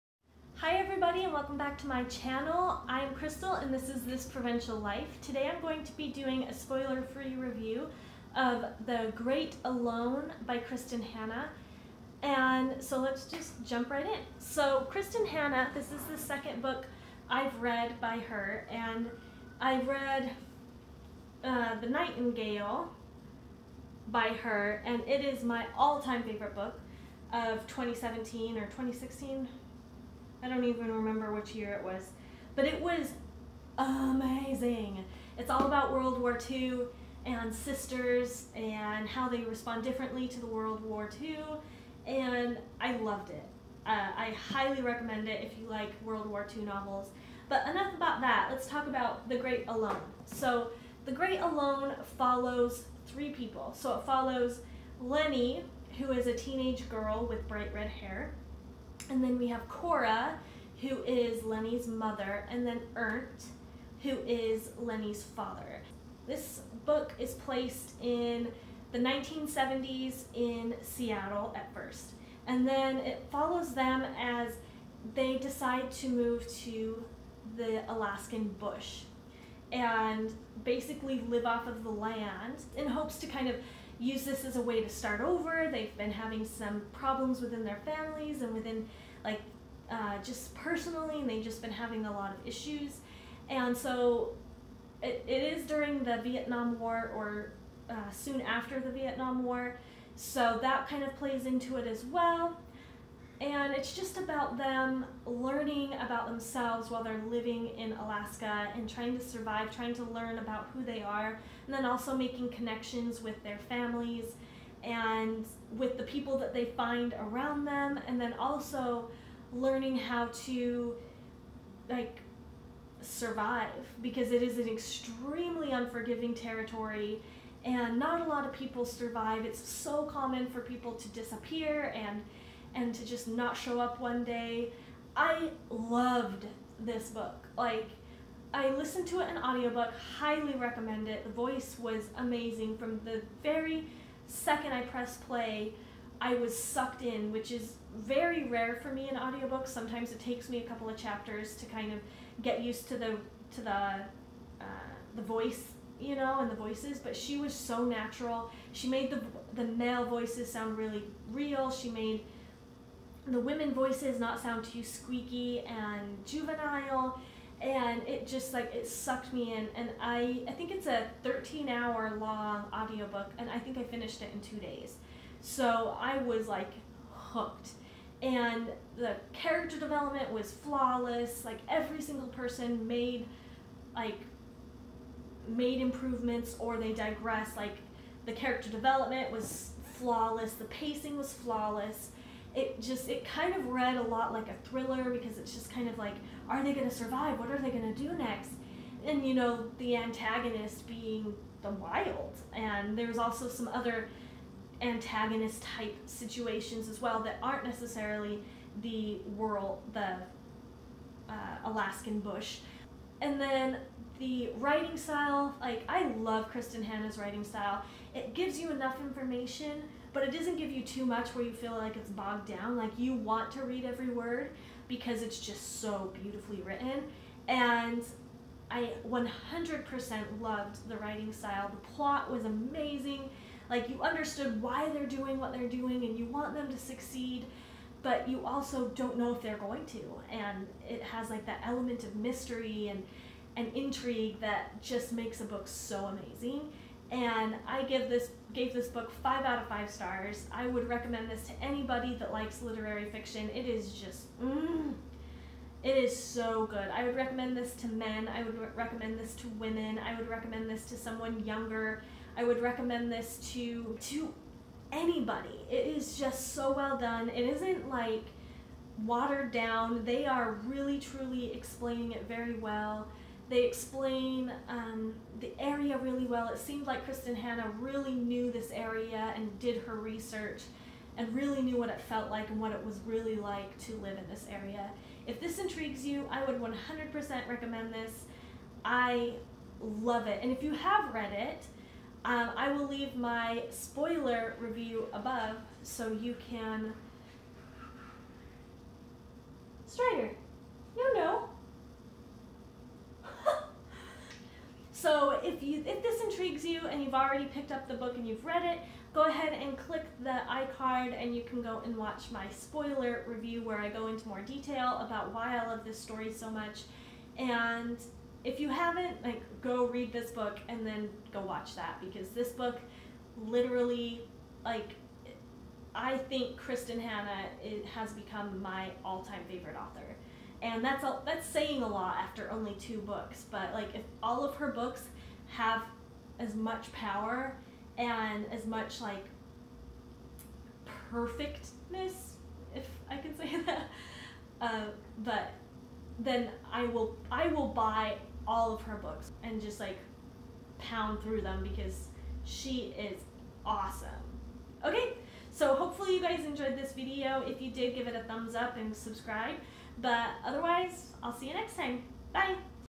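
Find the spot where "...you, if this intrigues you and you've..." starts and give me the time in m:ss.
5:05.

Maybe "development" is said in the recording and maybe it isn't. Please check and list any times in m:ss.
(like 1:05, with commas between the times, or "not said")
2:59, 3:08.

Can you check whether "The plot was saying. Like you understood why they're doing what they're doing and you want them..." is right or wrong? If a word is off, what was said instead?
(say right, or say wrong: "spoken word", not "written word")
wrong: "amazing", not "saying".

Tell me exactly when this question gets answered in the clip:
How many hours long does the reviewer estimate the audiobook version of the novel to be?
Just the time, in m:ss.
2:51.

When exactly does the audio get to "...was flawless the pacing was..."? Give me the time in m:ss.
3:09.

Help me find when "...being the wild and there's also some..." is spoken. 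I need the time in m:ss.
3:20.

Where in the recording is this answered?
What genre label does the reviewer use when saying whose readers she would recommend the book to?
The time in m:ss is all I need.
4:12.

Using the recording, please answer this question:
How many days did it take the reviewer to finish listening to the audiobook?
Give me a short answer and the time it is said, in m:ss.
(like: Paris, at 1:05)
2, at 2:54.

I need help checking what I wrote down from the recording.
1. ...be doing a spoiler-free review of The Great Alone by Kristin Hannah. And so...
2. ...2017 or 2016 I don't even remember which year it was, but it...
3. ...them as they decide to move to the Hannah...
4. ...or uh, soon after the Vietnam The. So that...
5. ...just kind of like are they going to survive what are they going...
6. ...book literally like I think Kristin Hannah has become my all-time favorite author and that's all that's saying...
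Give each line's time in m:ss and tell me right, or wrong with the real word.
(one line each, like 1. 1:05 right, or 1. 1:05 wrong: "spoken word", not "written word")
1. 0:05 right
2. 0:27 right
3. 1:13 wrong: "Alaskan", not "Hannah"
4. 1:37 wrong: "War", not "The"
5. 3:15 right
6. 5:22 right.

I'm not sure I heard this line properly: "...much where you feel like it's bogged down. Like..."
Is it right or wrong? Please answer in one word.
right.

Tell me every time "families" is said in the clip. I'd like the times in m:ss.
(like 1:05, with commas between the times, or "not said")
1:27, 1:53.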